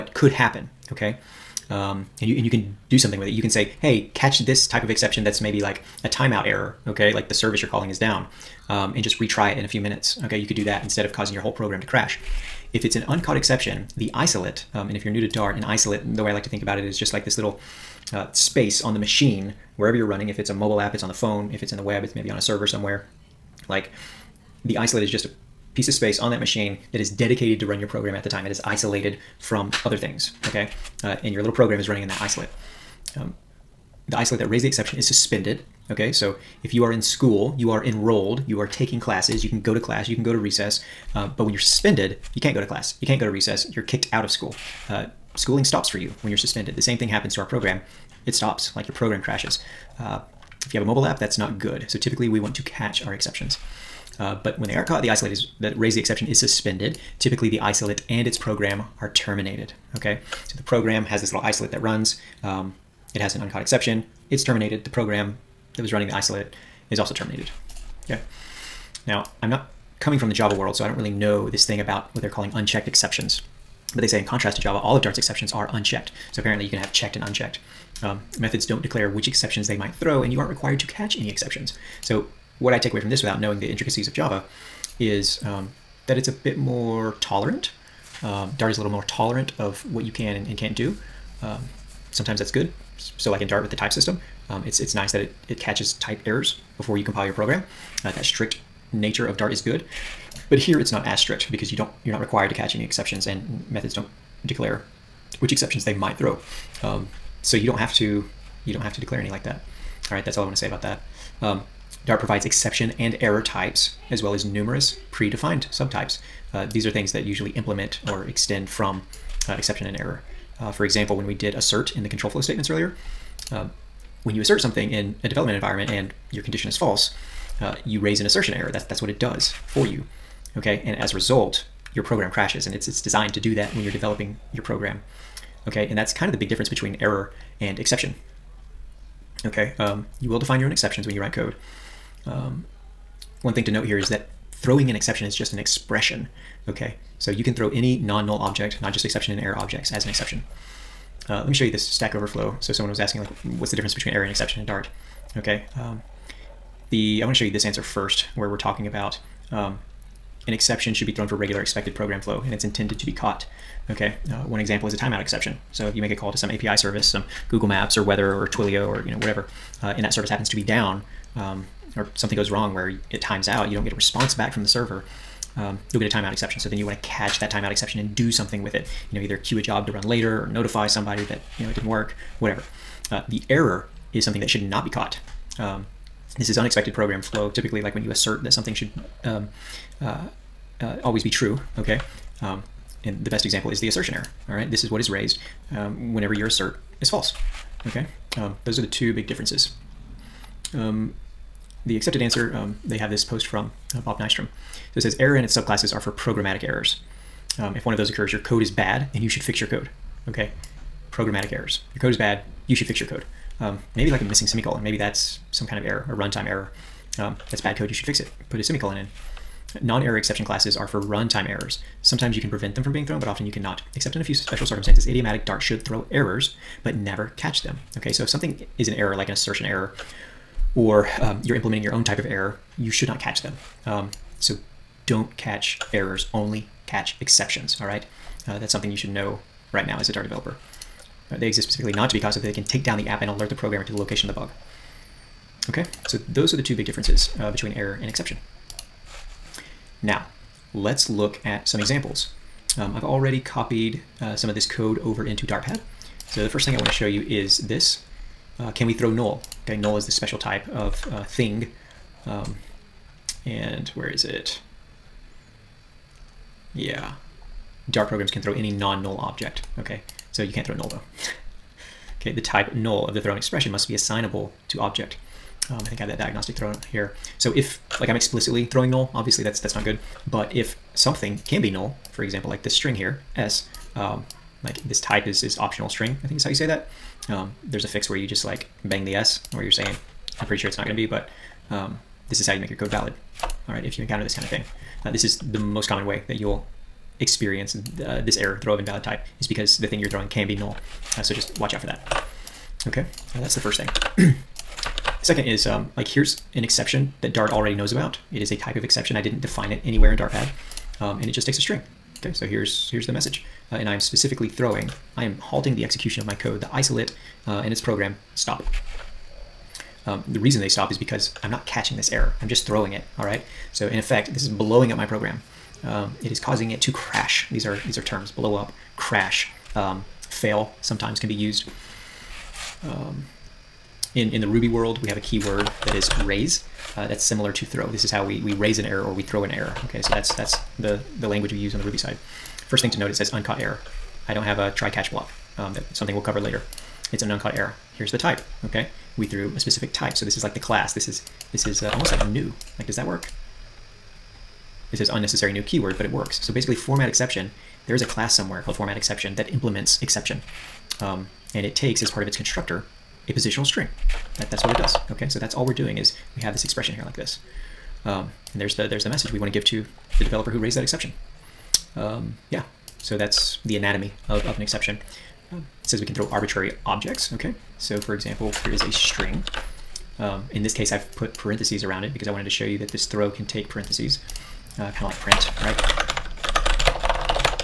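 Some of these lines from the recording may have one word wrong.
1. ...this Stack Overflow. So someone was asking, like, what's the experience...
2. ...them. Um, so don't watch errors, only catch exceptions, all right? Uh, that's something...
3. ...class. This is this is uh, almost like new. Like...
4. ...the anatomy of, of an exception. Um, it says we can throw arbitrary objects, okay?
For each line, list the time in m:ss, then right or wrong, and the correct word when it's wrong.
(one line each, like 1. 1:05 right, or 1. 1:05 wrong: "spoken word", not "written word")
1. 2:31 wrong: "difference", not "experience"
2. 3:53 wrong: "catch", not "watch"
3. 5:50 right
4. 6:13 right.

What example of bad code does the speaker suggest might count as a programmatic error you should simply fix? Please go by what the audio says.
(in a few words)
Missing semicolon.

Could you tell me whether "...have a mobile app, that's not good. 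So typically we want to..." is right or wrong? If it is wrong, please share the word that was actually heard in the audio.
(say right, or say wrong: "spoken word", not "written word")
right.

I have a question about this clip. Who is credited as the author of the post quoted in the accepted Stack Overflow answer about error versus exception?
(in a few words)
Bob Nystrom.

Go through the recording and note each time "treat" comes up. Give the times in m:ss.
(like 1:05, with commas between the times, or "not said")
not said.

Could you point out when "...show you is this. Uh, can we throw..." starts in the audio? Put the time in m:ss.
4:16.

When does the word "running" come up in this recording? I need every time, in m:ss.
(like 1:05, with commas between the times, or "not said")
0:20, 0:31, 1:05.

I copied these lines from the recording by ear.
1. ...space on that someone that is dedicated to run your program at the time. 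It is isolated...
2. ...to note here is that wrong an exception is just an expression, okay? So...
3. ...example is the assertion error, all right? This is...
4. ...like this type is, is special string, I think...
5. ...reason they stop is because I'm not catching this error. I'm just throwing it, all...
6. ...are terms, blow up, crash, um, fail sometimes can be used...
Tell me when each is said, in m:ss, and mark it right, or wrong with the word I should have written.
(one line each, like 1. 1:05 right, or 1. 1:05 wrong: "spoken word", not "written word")
1. 0:25 wrong: "machine", not "someone"
2. 2:23 wrong: "throwing", not "wrong"
3. 3:13 right
4. 4:44 wrong: "optional", not "special"
5. 5:20 right
6. 5:27 right.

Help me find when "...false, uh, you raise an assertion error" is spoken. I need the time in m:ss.
2:06.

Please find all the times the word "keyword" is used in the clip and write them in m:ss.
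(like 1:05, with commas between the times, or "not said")
5:35, 5:55.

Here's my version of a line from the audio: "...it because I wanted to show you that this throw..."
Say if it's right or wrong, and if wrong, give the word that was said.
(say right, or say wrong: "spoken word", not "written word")
right.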